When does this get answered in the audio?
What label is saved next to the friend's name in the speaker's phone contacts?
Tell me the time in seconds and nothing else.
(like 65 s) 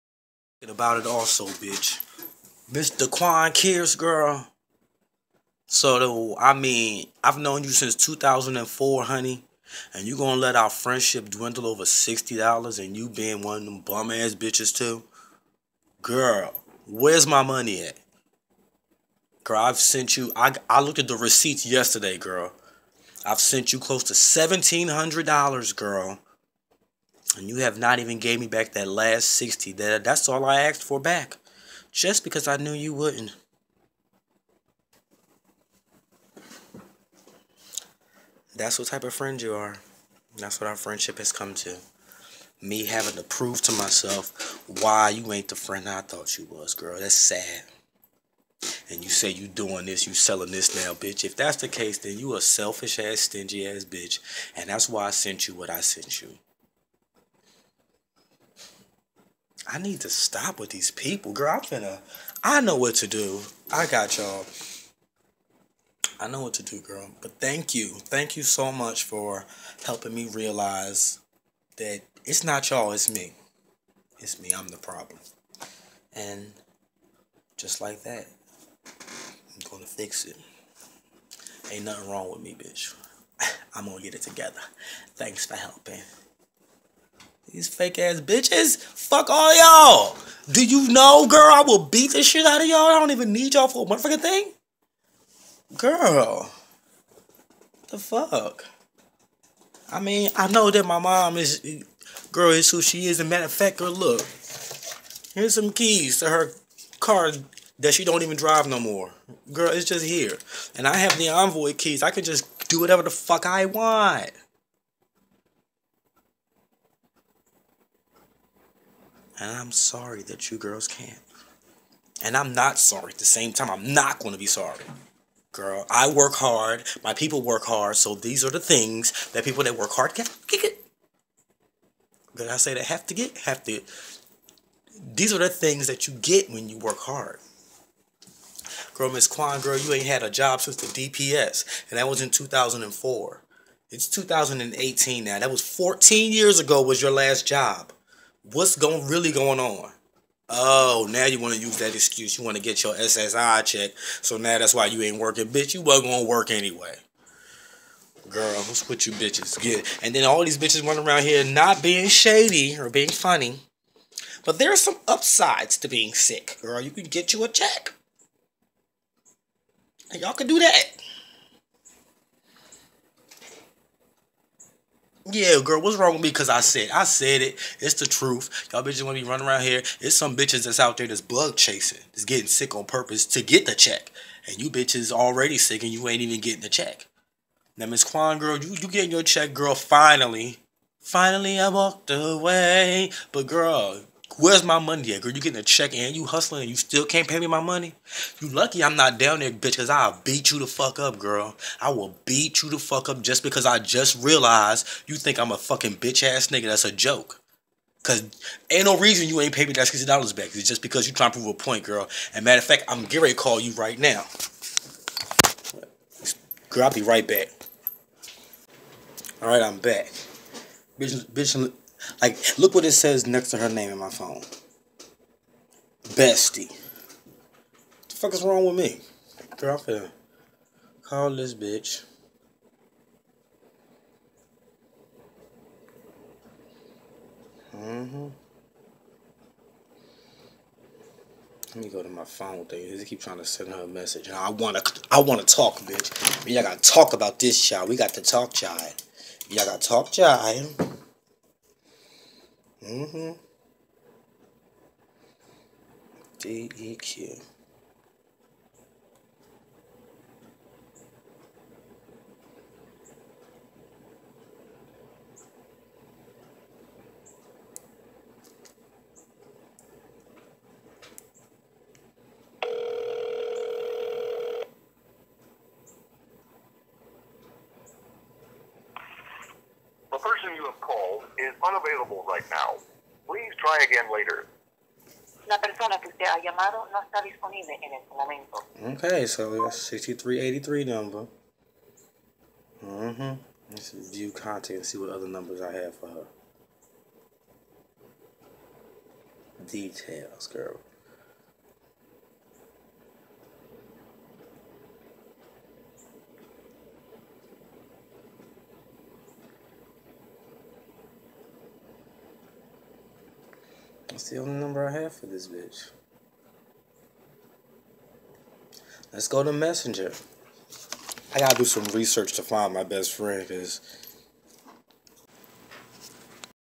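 226 s.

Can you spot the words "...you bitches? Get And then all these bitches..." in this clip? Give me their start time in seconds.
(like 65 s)
159 s.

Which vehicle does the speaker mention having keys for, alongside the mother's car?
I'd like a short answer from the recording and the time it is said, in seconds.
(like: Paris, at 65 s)
Envoy, at 111 s.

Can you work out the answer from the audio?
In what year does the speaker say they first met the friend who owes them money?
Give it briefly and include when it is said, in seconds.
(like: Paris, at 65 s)
2004, at 7 s.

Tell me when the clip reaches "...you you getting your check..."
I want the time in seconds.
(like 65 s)
188 s.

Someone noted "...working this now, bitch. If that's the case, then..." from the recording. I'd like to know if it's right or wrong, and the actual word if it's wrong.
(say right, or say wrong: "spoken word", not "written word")
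wrong: "selling", not "working".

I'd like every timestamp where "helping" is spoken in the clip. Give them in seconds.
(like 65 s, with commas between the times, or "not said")
69 s, 85 s.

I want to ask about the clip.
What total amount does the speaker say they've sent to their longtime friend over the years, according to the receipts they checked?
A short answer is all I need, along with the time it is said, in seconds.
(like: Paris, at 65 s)
$1,700, at 24 s.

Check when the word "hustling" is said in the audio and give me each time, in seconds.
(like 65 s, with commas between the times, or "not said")
196 s.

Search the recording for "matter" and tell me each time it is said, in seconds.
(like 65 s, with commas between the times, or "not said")
103 s, 212 s.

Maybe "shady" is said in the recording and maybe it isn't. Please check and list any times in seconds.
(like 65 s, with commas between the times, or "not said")
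162 s.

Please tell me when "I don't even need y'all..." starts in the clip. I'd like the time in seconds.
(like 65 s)
92 s.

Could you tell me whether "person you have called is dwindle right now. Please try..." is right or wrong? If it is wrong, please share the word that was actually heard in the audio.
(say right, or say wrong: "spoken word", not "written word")
wrong: "unavailable", not "dwindle".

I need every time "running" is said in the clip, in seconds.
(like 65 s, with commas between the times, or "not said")
160 s, 179 s.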